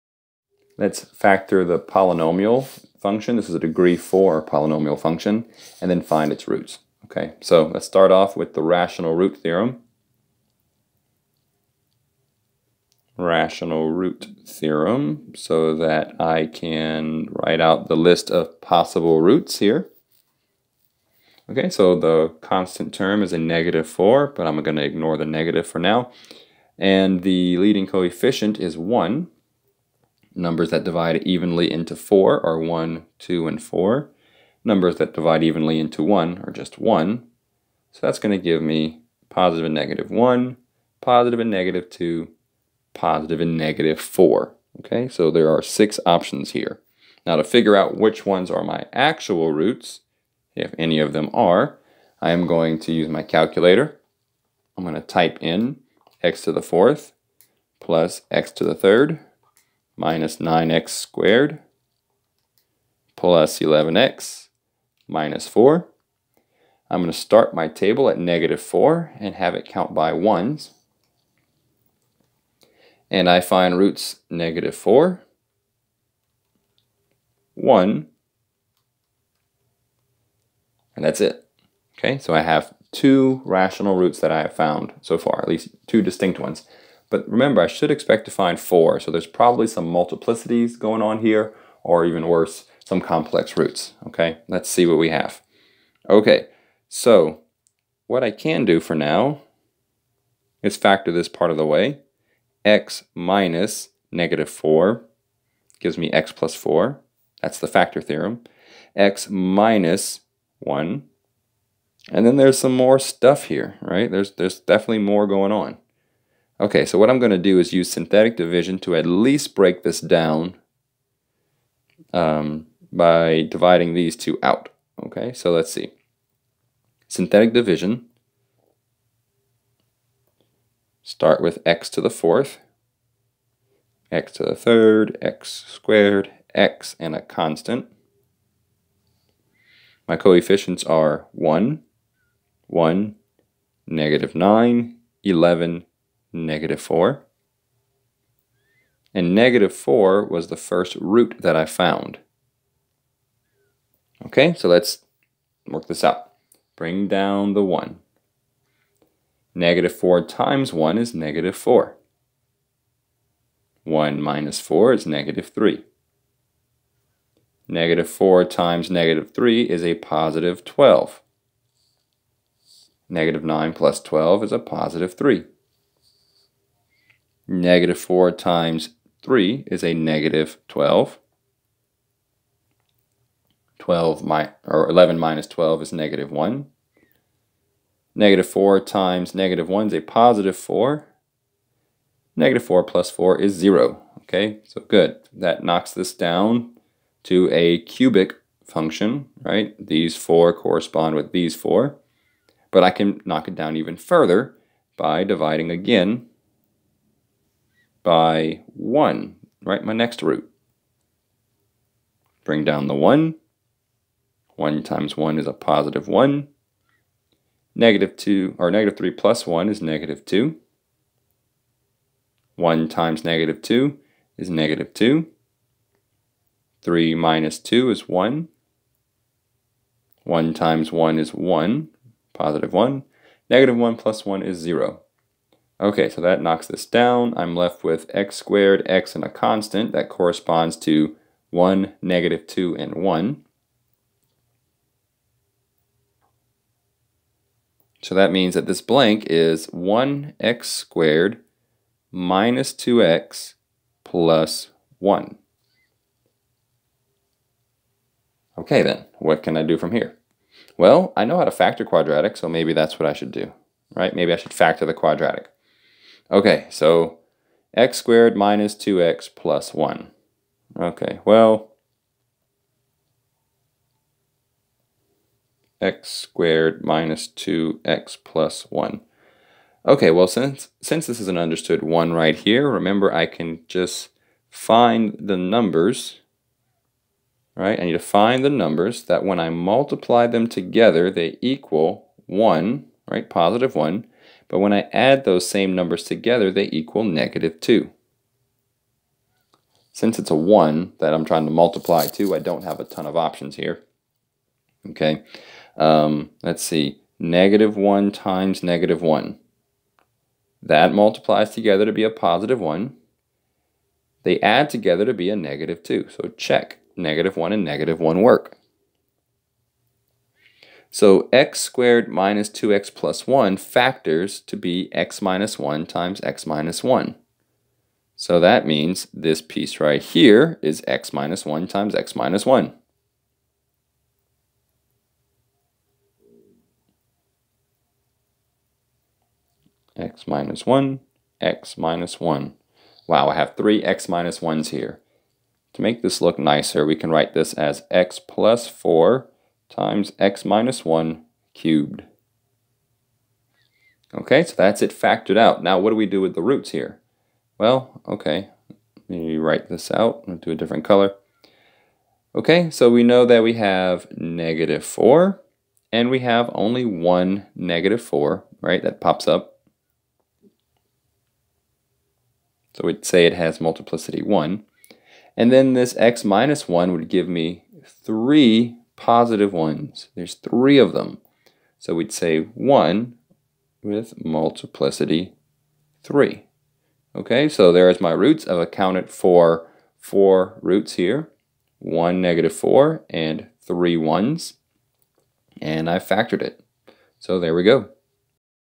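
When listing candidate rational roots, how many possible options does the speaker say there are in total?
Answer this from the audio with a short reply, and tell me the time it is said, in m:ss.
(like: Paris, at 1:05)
6, at 0:45.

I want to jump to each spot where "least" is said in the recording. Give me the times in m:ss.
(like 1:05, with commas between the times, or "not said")
1:25, 1:59.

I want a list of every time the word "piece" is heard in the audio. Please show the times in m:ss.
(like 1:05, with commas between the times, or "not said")
5:29.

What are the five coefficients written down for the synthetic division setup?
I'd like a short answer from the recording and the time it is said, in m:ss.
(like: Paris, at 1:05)
1, 1, -9, 11, -4, at 2:21.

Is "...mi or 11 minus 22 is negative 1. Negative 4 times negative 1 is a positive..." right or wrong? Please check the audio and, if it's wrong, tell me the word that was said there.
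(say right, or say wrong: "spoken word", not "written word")
wrong: "12", not "22".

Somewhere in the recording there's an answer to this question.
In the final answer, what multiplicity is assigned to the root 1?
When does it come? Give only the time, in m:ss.
6:22.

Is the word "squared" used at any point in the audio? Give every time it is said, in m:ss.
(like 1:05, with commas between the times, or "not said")
1:00, 2:15, 3:58, 4:10, 4:27, 4:36, 5:21.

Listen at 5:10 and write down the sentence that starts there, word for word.
That multiplies together to be a positive 1.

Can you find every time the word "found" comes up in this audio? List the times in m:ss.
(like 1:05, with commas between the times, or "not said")
1:24, 2:31.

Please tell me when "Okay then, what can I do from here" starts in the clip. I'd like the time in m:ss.
4:18.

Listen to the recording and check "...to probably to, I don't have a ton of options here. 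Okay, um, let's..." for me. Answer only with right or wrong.
wrong.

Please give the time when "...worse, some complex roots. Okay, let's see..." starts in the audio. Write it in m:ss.
1:32.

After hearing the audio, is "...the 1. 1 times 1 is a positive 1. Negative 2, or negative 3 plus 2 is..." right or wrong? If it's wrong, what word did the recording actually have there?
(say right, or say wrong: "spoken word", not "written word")
wrong: "1", not "2".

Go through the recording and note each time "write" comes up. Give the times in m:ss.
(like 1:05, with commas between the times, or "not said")
0:17, 5:47, 5:59.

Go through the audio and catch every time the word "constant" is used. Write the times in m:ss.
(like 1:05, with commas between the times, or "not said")
0:22, 2:17, 3:59.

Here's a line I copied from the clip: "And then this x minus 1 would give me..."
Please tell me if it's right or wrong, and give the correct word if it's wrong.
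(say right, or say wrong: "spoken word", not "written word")
right.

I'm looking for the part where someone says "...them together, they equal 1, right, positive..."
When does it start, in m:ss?
4:50.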